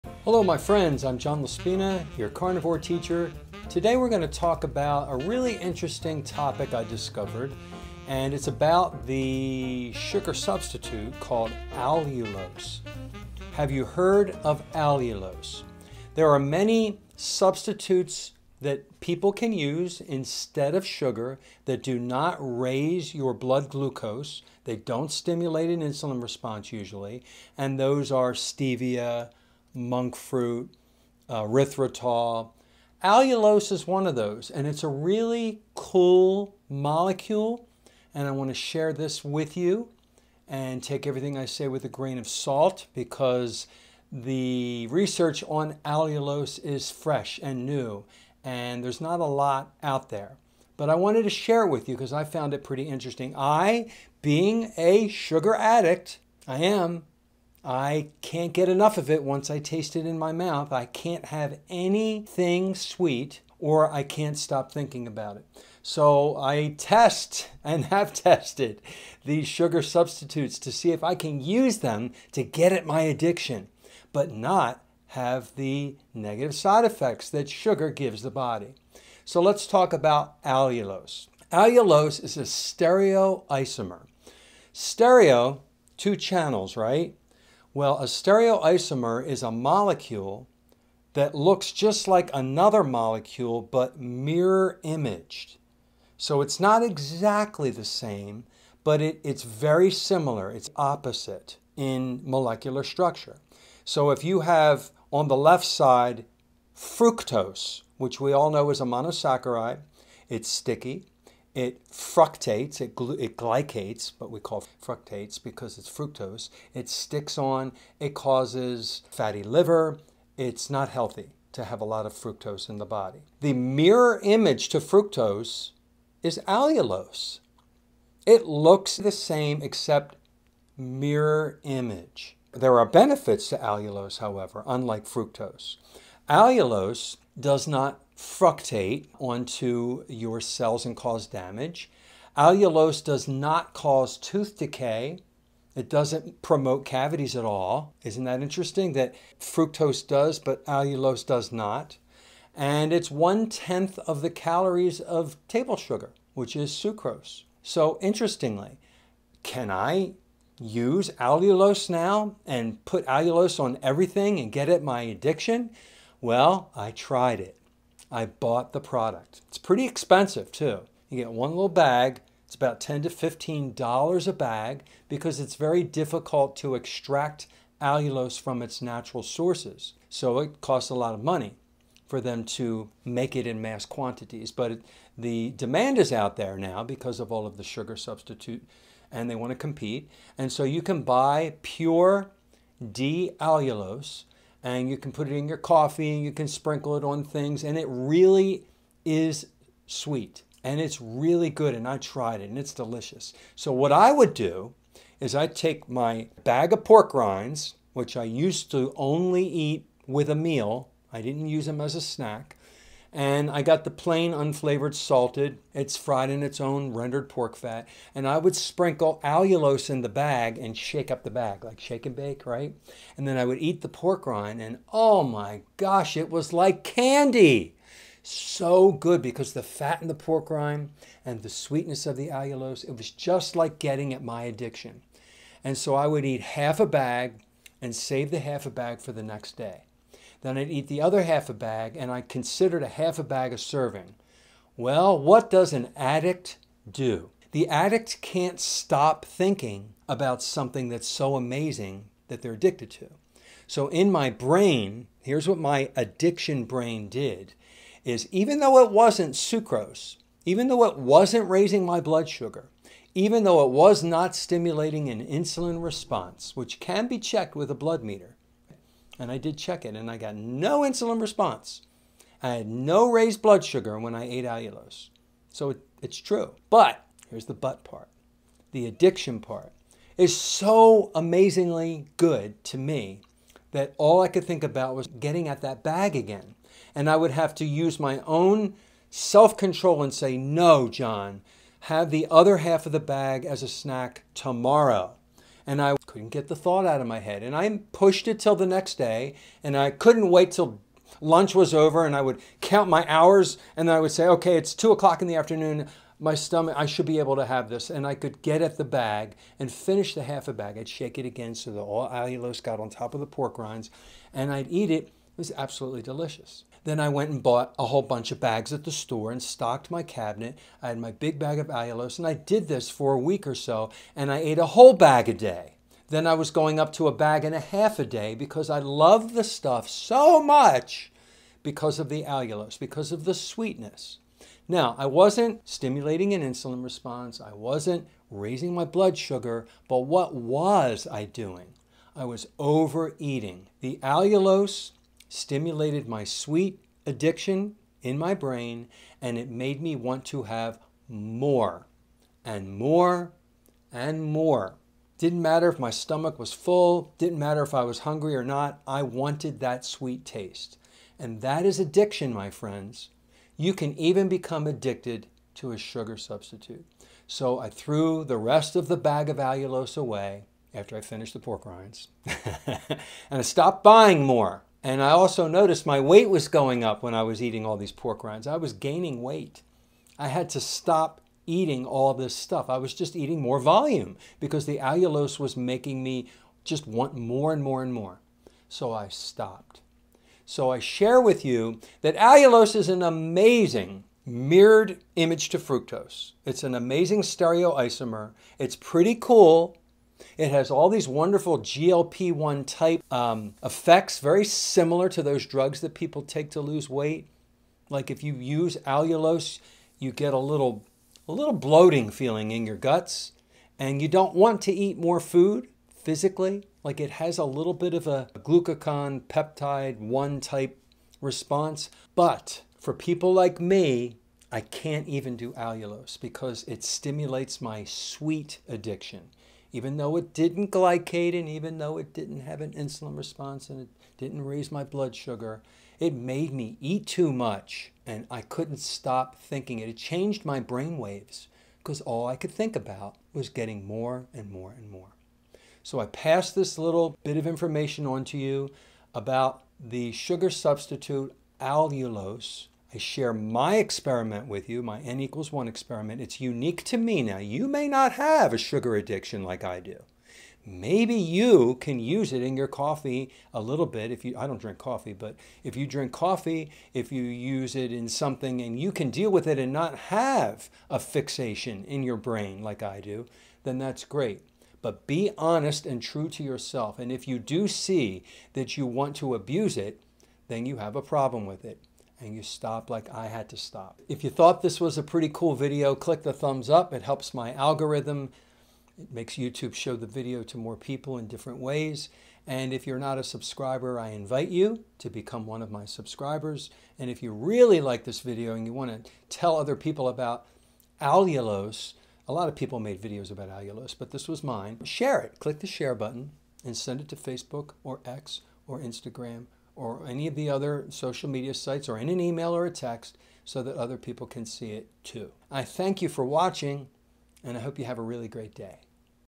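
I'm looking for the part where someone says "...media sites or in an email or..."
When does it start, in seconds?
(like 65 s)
511 s.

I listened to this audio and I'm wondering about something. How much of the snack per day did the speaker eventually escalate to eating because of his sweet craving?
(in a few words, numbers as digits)
a bag and a half.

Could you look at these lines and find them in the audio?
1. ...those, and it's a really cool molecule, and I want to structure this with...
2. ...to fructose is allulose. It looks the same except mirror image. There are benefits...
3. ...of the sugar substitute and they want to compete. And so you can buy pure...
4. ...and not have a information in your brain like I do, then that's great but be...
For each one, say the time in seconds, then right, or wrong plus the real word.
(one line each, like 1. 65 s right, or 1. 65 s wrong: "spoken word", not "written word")
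1. 34 s wrong: "share", not "structure"
2. 124 s right
3. 187 s right
4. 469 s wrong: "fixation", not "information".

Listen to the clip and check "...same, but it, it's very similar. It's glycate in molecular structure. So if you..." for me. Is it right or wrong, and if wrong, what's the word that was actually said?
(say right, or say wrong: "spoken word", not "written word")
wrong: "opposite", not "glycate".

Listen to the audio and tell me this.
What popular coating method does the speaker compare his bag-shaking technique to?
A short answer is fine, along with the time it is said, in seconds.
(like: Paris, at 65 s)
shake and bake, at 221 s.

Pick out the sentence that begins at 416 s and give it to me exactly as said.
Like it has a little bit of a glucagon peptide 1 type response.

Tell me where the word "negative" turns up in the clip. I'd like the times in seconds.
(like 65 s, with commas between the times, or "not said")
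76 s.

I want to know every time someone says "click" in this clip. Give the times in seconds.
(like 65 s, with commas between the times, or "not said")
485 s, 505 s.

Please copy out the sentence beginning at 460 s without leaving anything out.
Maybe you can use it in your coffee a little bit.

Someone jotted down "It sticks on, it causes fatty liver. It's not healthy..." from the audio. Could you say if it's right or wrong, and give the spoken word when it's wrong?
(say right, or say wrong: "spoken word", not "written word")
right.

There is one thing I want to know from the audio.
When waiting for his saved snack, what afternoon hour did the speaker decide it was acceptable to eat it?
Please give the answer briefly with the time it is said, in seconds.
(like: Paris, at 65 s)
2 o'clock, at 304 s.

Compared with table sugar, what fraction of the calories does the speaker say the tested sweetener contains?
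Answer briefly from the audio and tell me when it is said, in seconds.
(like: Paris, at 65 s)
one tenth, at 153 s.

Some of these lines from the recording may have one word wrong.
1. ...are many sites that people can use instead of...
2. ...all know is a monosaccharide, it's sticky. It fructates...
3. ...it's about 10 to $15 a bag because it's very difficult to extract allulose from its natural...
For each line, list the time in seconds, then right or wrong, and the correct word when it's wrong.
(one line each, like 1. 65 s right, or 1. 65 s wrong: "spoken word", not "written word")
1. 16 s wrong: "substitutes", not "sites"
2. 108 s right
3. 172 s right.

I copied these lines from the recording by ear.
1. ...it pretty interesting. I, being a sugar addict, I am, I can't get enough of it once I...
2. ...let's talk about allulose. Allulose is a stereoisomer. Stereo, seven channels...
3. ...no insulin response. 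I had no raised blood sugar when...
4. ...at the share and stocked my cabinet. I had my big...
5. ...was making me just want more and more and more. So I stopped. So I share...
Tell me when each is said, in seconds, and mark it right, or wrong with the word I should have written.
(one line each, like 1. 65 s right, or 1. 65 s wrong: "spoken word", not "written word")
1. 52 s right
2. 79 s wrong: "two", not "seven"
3. 270 s right
4. 318 s wrong: "store", not "share"
5. 385 s right.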